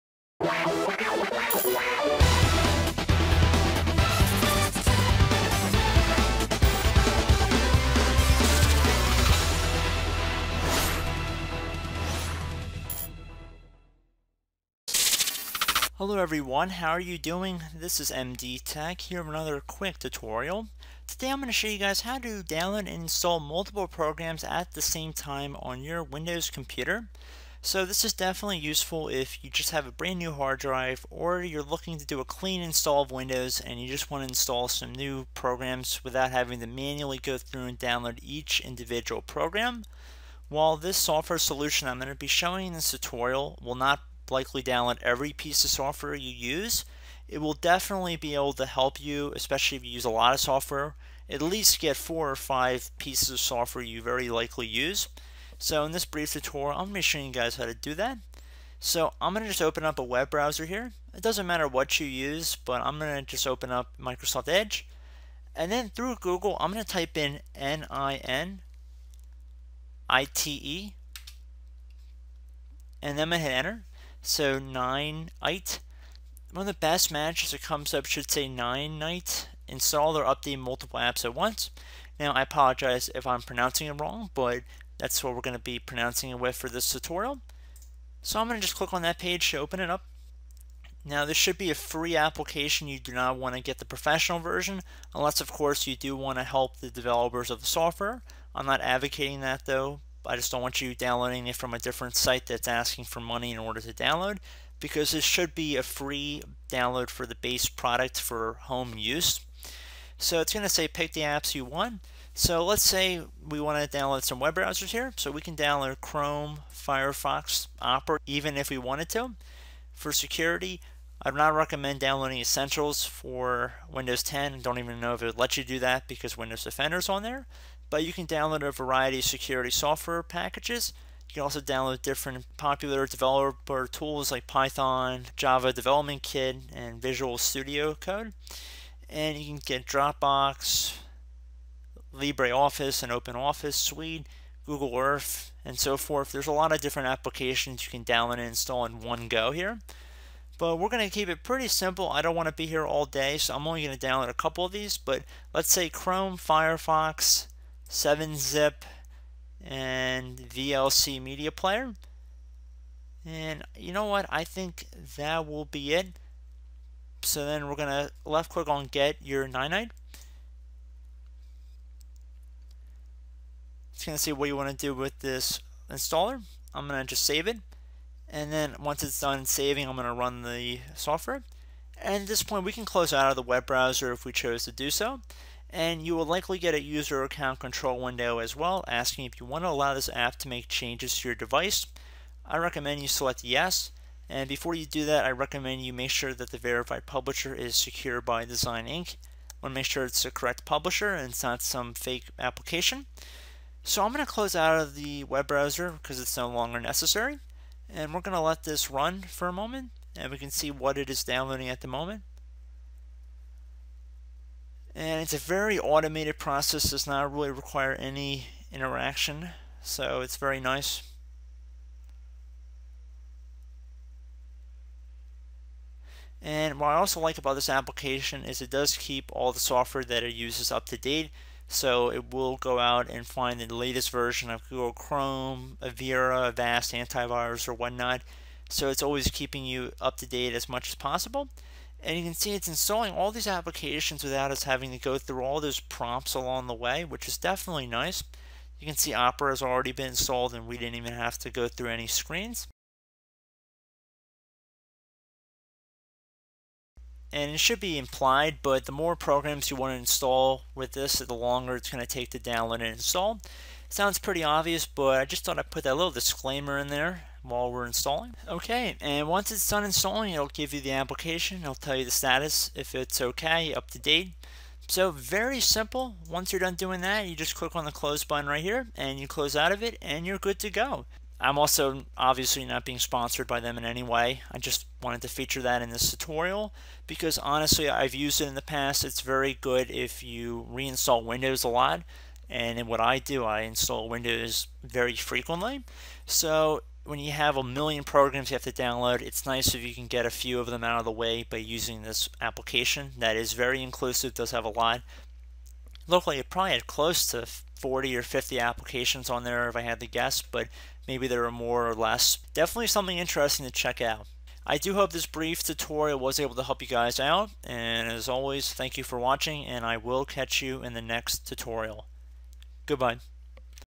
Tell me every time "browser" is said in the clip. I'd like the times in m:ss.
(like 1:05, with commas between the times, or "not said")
1:00, 1:54, 3:03, 3:25.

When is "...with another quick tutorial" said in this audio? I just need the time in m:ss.
0:19.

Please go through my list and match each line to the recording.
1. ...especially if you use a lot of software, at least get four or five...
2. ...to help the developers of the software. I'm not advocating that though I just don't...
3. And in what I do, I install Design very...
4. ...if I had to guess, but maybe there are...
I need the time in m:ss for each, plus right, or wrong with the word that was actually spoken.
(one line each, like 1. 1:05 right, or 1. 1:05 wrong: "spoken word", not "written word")
1. 0:49 right
2. 1:36 right
3. 4:52 wrong: "Windows", not "Design"
4. 5:09 right.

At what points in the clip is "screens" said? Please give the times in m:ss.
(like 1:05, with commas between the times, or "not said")
4:12.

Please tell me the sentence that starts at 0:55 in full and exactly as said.
So in this brief tutorial, I'm going to show you guys how to do that.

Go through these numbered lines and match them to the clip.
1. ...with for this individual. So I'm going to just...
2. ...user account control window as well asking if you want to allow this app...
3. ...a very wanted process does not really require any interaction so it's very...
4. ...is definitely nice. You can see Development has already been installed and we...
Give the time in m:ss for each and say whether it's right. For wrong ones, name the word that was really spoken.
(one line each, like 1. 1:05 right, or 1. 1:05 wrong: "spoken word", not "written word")
1. 1:26 wrong: "tutorial", not "individual"
2. 3:06 right
3. 3:35 wrong: "automated", not "wanted"
4. 4:07 wrong: "Opera", not "Development".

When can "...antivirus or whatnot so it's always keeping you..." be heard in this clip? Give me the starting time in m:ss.
3:56.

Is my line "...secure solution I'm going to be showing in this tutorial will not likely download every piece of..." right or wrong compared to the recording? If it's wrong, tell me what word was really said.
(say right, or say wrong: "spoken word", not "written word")
wrong: "software", not "secure".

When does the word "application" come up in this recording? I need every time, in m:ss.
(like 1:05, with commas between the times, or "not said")
1:32, 2:27, 3:22, 3:47, 4:03, 4:30, 5:02, 5:08.